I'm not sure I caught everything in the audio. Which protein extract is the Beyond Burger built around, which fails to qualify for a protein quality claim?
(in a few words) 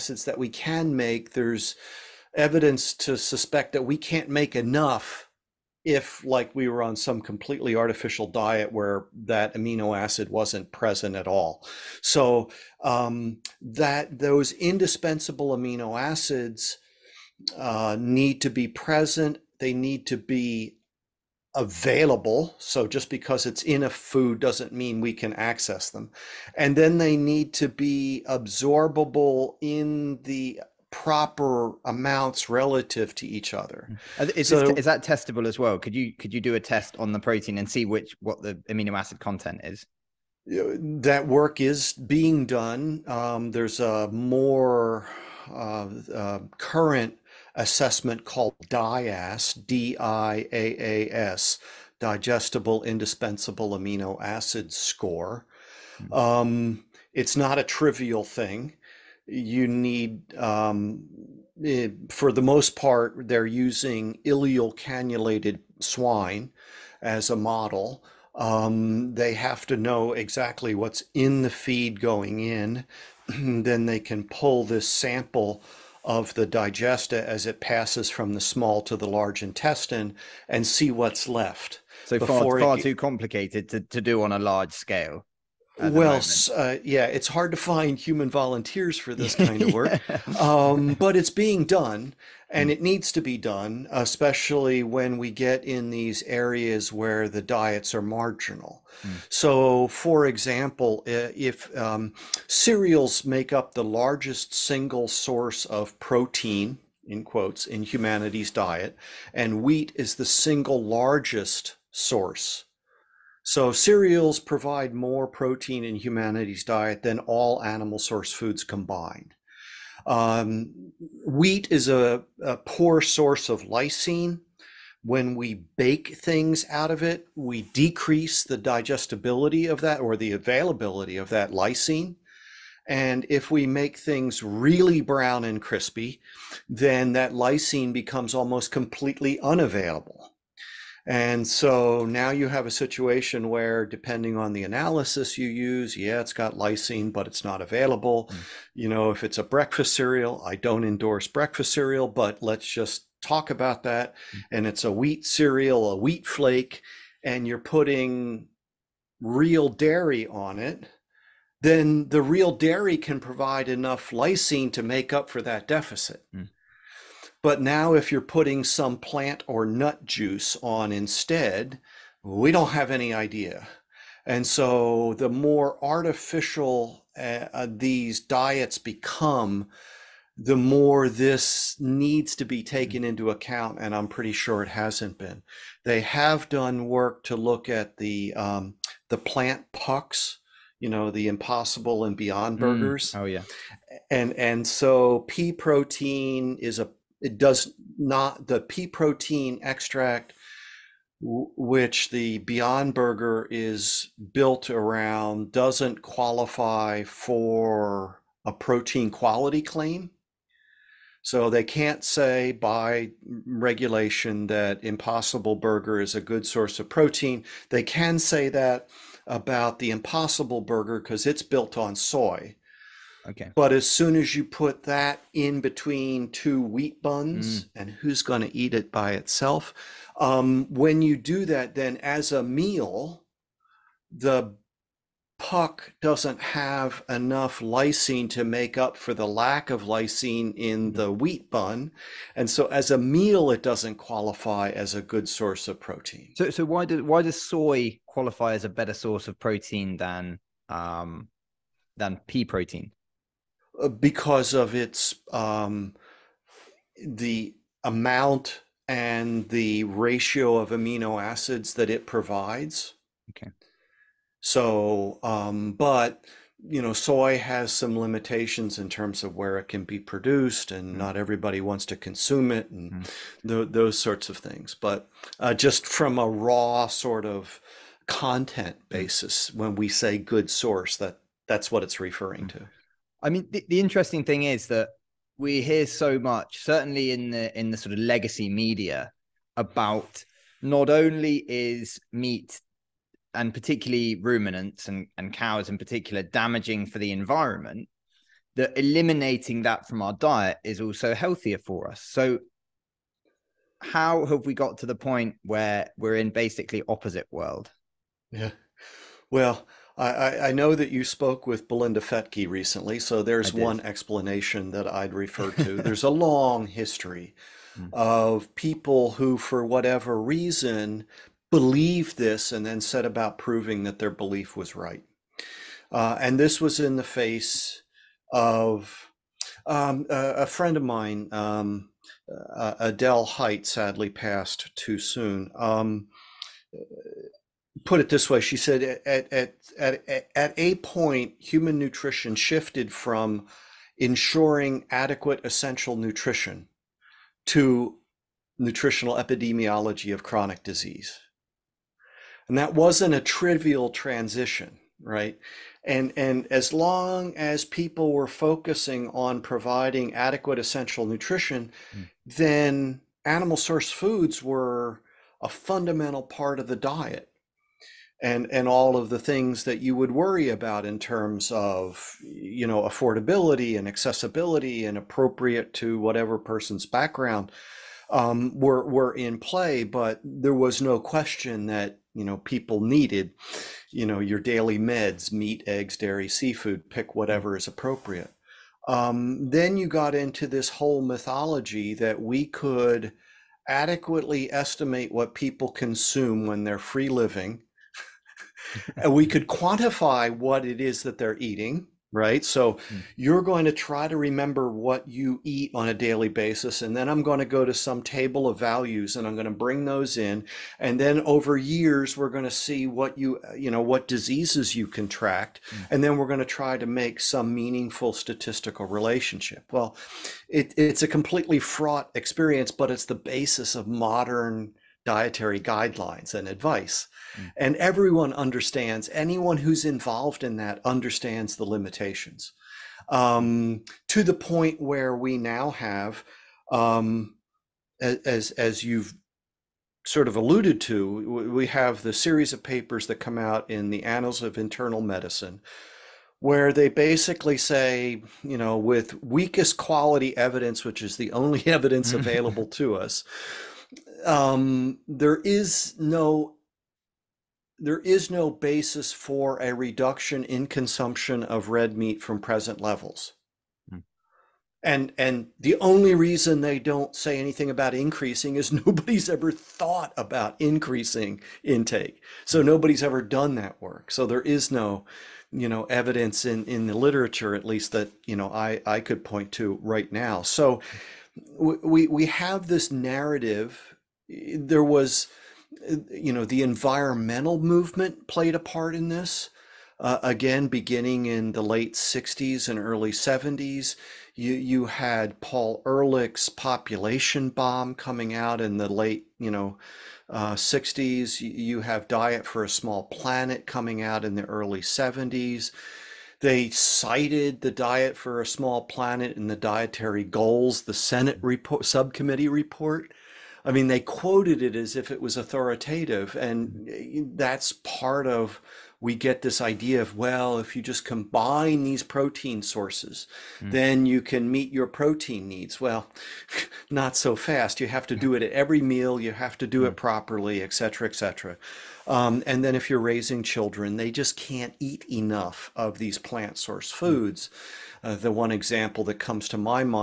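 pea protein extract.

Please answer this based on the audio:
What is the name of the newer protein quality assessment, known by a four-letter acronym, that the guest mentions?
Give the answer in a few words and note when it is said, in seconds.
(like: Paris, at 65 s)
digestible indispensable amino acid score, at 51 s.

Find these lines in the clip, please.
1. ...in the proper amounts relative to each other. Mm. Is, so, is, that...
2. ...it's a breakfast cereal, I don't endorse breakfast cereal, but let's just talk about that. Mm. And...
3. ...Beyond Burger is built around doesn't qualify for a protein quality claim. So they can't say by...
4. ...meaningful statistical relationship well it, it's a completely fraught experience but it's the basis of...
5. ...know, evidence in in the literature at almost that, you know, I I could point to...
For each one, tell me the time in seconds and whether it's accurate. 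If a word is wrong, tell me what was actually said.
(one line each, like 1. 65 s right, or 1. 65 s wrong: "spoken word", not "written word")
1. 29 s right
2. 149 s right
3. 202 s right
4. 417 s right
5. 475 s wrong: "least", not "almost".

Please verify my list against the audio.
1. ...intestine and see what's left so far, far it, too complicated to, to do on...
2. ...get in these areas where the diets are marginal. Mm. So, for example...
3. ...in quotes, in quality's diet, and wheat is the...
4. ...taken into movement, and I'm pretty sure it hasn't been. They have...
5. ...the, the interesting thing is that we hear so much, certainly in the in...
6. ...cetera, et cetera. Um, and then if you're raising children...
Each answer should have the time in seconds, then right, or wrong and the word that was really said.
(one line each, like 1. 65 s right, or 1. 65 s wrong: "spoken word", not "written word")
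1. 79 s right
2. 95 s right
3. 107 s wrong: "humanity", not "quality"
4. 182 s wrong: "account", not "movement"
5. 283 s right
6. 530 s right.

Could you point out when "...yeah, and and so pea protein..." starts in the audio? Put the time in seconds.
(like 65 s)
193 s.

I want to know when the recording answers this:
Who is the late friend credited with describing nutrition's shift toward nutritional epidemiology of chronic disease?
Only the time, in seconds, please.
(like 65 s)
332 s.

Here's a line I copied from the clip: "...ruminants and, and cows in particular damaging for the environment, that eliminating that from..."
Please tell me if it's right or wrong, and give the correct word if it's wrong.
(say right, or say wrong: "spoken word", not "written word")
right.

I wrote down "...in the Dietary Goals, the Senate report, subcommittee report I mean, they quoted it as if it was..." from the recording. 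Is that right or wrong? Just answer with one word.
right.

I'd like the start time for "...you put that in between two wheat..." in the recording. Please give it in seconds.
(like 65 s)
224 s.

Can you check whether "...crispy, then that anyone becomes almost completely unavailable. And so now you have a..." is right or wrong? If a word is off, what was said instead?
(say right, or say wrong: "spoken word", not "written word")
wrong: "lysine", not "anyone".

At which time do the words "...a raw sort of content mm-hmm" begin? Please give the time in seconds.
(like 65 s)
276 s.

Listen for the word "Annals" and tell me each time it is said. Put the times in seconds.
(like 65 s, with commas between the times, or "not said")
444 s.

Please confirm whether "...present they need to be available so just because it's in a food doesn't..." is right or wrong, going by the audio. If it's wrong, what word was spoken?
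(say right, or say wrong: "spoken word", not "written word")
right.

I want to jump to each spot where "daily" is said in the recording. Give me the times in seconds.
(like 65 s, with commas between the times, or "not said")
384 s, 405 s.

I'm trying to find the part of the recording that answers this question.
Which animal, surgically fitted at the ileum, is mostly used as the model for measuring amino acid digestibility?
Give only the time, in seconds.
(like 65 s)
65 s.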